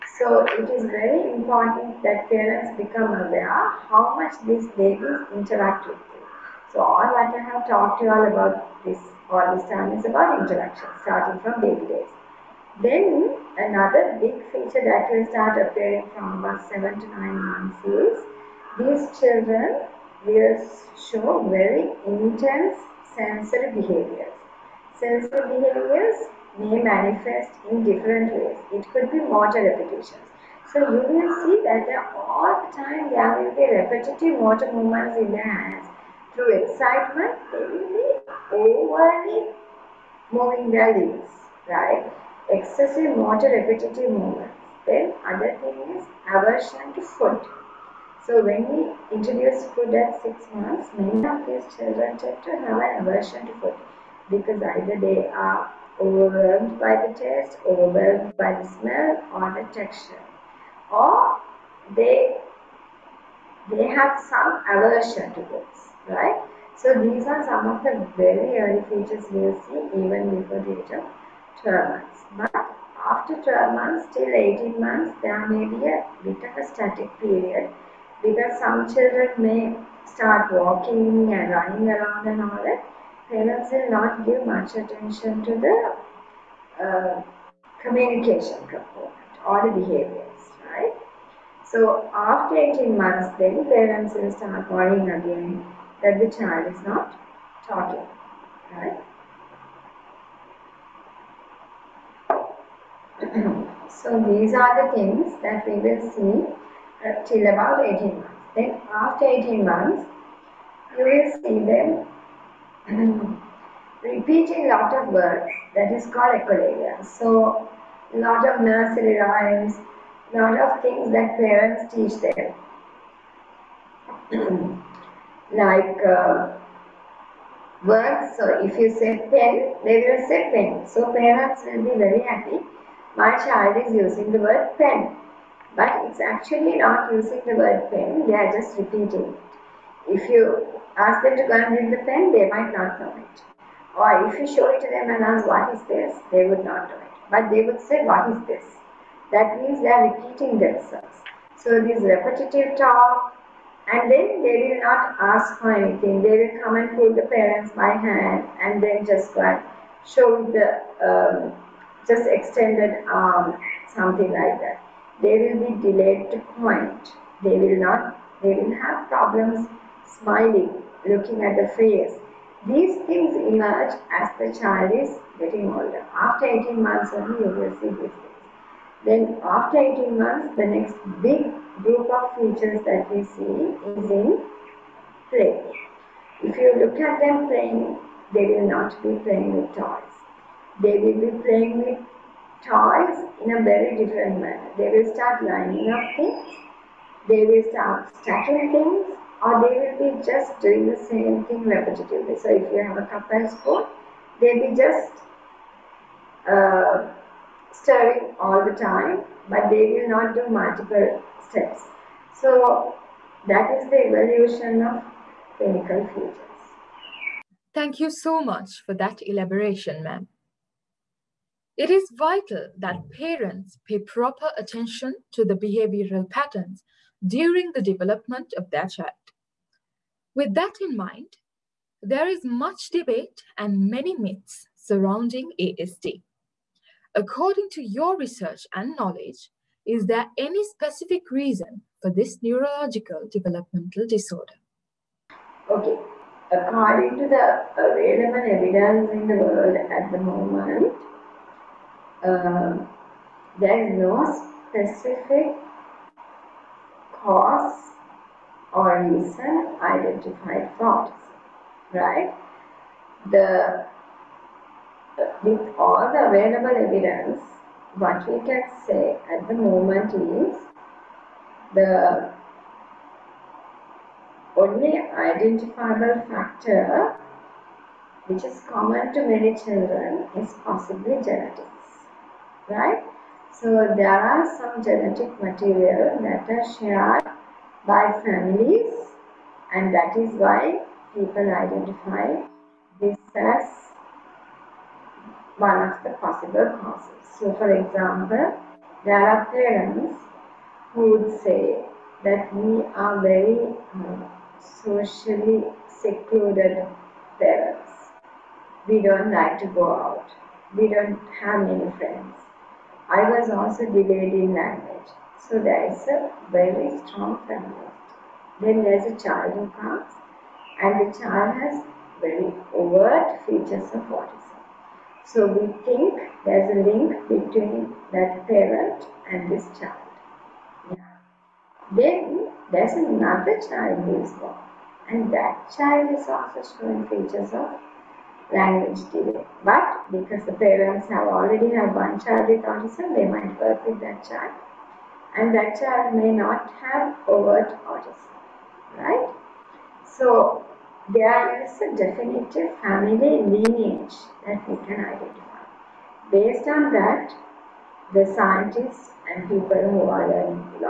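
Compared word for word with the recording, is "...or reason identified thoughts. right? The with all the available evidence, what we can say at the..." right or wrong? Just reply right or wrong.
right.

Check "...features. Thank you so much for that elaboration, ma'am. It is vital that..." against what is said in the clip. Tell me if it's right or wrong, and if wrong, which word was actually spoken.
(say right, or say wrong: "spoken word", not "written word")
right.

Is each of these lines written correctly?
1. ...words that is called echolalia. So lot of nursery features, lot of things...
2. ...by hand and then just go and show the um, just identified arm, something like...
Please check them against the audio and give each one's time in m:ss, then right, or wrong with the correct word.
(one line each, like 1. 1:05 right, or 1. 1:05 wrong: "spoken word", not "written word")
1. 1:55 wrong: "rhymes", not "features"
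2. 2:37 wrong: "extended", not "identified".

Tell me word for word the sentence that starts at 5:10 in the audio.
We don't have many friends I was also delayed in language.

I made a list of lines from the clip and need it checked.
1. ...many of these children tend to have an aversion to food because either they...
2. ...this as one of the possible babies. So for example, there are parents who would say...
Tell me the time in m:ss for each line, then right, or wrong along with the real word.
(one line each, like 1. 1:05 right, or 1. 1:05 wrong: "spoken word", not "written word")
1. 0:50 right
2. 4:52 wrong: "causes", not "babies".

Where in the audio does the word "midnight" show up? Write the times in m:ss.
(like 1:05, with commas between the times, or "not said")
not said.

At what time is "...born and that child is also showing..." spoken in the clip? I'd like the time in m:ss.
5:34.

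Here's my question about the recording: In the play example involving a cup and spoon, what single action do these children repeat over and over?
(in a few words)
Stirring.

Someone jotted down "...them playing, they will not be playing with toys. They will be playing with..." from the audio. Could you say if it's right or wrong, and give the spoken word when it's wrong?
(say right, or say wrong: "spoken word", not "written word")
right.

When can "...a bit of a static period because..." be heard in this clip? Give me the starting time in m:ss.
1:15.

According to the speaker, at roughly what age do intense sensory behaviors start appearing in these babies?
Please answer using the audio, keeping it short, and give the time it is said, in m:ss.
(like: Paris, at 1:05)
7 to 9 months, at 0:16.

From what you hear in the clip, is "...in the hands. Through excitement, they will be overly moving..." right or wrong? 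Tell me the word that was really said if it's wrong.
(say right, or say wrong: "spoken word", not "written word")
right.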